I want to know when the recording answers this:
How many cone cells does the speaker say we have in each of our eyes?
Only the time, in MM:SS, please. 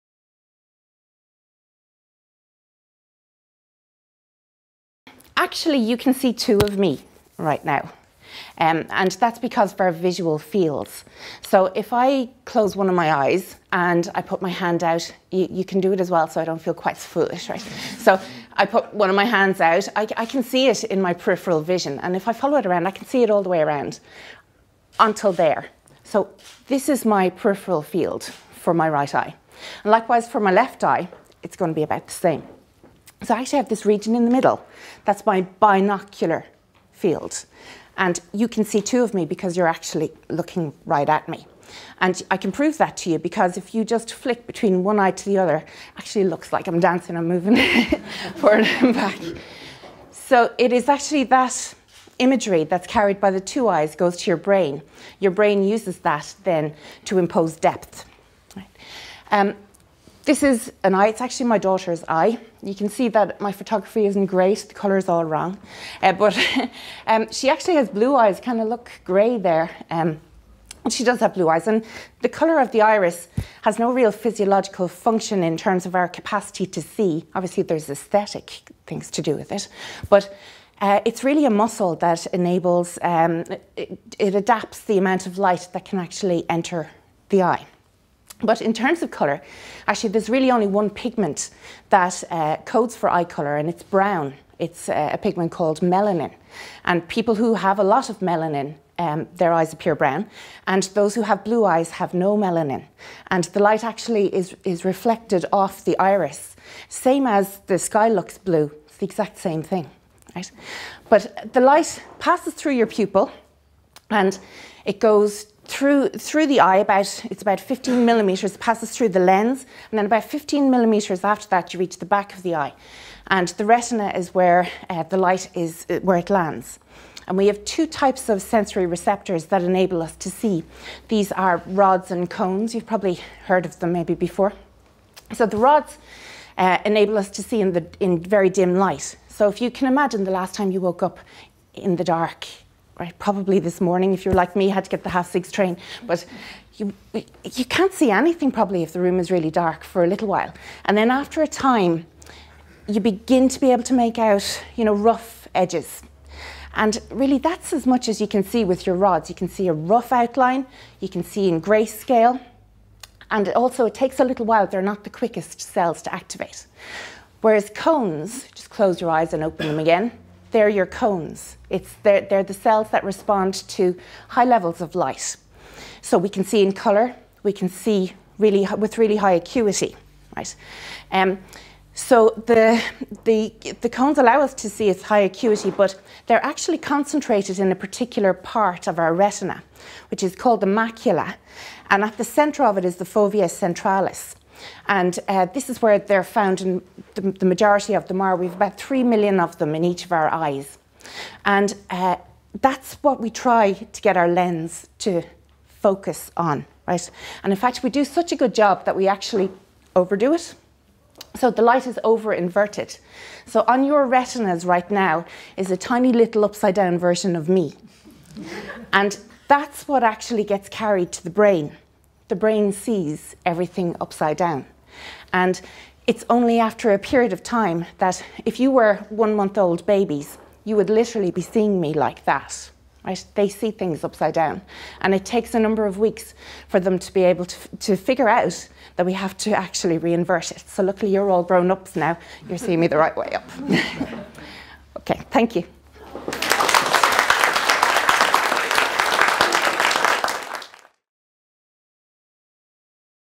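03:18.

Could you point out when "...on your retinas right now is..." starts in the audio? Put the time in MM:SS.
03:33.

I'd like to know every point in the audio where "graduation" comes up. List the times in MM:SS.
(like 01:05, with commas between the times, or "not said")
not said.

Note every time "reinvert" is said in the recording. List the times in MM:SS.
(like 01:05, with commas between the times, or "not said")
03:59.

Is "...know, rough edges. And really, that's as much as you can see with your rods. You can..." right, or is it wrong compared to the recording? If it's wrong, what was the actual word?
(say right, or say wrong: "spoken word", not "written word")
right.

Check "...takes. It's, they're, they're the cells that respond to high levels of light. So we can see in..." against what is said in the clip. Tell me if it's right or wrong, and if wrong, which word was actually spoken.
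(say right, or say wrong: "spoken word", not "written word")
wrong: "cones", not "takes".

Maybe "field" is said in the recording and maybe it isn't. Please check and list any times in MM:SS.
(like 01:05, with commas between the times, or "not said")
00:10, 00:27, 00:36.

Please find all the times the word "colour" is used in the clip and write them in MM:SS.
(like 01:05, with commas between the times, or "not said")
01:12, 01:29, 01:33, 02:56.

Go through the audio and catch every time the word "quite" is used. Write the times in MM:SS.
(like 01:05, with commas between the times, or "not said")
00:16.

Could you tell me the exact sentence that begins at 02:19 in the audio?
So if you can imagine the last time you woke up in the dark, right?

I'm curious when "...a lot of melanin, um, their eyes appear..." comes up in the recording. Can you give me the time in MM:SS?
01:37.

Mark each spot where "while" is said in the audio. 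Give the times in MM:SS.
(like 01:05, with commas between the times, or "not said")
02:30, 02:44.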